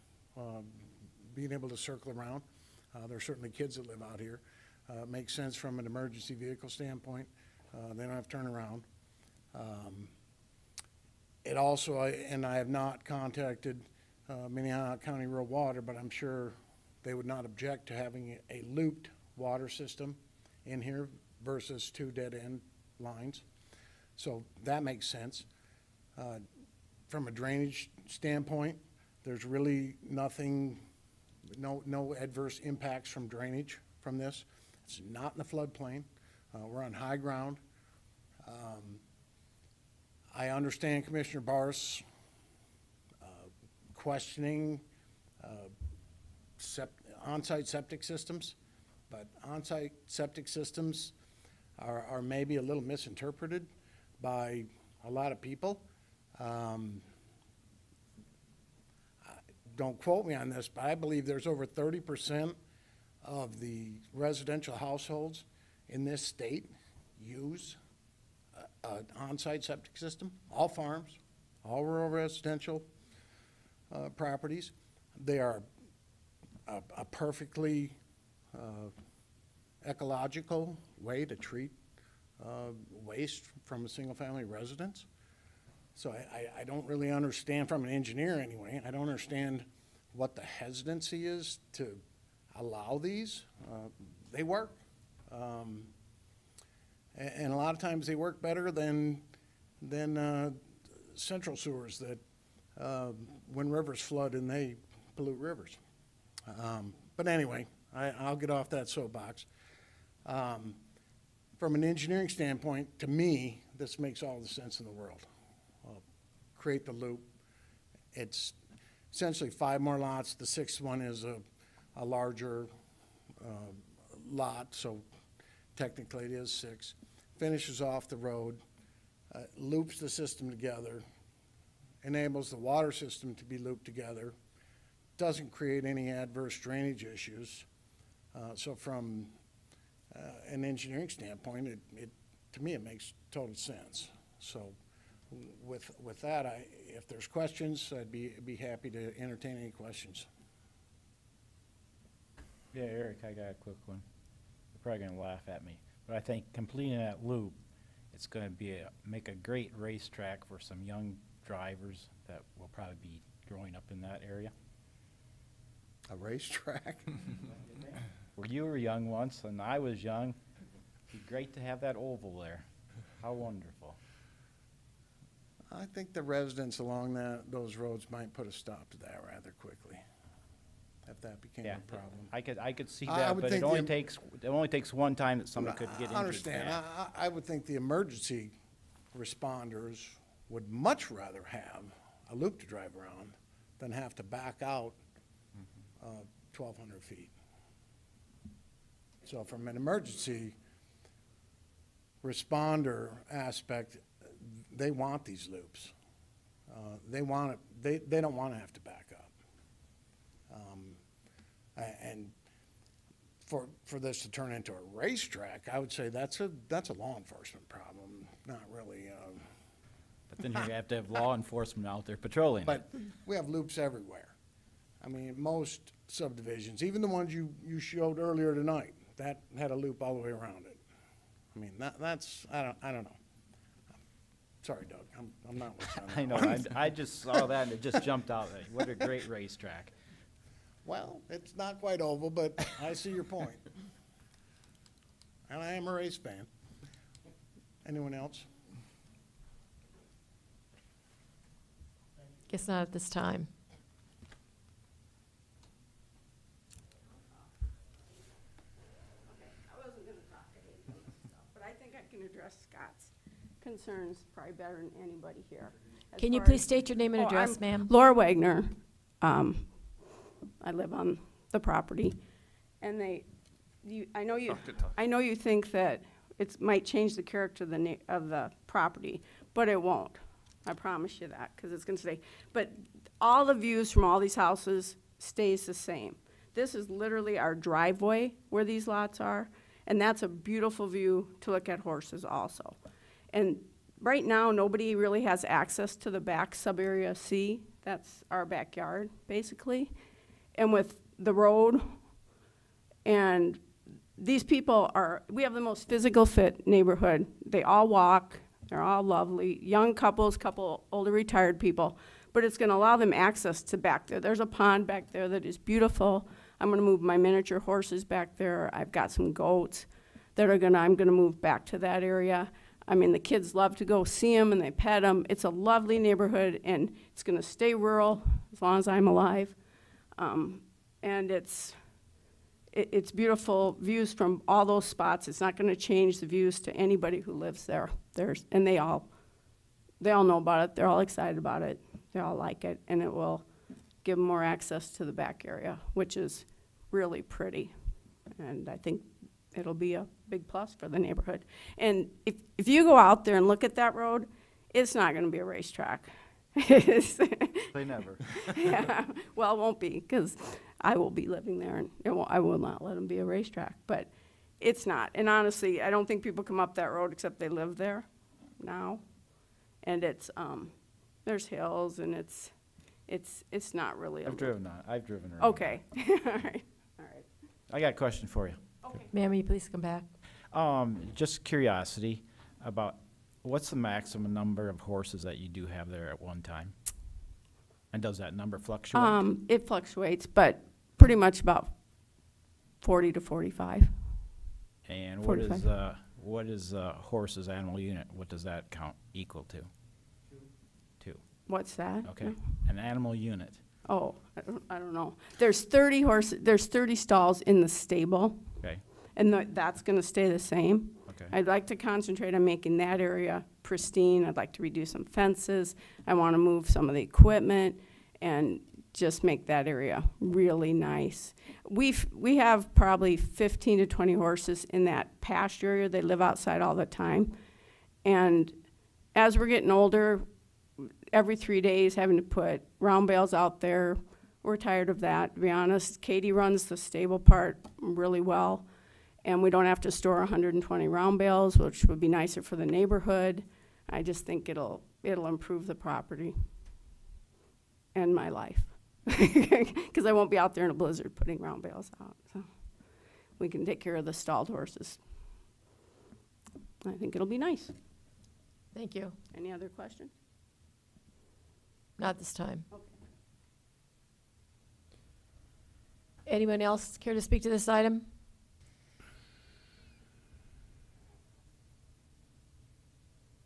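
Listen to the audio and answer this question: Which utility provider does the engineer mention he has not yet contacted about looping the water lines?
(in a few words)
Minnehaha County Rural Water.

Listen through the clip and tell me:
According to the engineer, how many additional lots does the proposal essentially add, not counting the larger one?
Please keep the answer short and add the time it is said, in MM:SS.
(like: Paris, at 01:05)
5, at 01:59.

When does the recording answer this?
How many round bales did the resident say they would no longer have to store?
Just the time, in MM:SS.
07:20.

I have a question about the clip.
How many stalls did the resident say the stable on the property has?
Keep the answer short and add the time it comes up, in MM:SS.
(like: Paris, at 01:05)
30, at 06:46.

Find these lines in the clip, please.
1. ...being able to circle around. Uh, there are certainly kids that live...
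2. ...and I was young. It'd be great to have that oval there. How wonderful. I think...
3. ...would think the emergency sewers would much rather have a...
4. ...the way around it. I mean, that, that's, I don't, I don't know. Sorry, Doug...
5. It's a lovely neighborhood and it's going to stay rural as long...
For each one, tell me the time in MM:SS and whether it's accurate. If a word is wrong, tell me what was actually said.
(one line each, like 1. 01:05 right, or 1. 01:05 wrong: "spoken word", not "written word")
1. 00:01 right
2. 02:49 right
3. 03:07 wrong: "responders", not "sewers"
4. 03:50 right
5. 05:25 right.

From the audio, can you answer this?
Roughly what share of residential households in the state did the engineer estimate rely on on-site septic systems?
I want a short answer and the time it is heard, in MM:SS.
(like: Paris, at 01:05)
30%, at 01:01.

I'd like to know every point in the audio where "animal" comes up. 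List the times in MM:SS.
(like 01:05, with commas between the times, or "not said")
06:37, 06:42.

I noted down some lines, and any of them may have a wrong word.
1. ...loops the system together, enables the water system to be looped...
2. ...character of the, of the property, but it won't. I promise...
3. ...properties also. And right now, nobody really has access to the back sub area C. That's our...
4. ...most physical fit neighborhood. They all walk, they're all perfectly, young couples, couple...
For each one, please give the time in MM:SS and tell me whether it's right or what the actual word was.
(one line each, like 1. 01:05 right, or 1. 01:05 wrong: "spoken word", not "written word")
1. 02:09 right
2. 04:37 right
3. 04:51 wrong: "horses", not "properties"
4. 05:05 wrong: "lovely", not "perfectly".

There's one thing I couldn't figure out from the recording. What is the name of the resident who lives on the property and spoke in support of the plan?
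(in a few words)
Laura Wagner.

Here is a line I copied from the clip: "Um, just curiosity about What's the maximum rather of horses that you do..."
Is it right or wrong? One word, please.
wrong.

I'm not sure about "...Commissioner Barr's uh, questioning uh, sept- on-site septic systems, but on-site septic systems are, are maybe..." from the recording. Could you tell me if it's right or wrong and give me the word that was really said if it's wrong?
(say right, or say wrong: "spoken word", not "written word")
right.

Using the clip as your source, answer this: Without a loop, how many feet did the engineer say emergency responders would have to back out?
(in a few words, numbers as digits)
1200 feet.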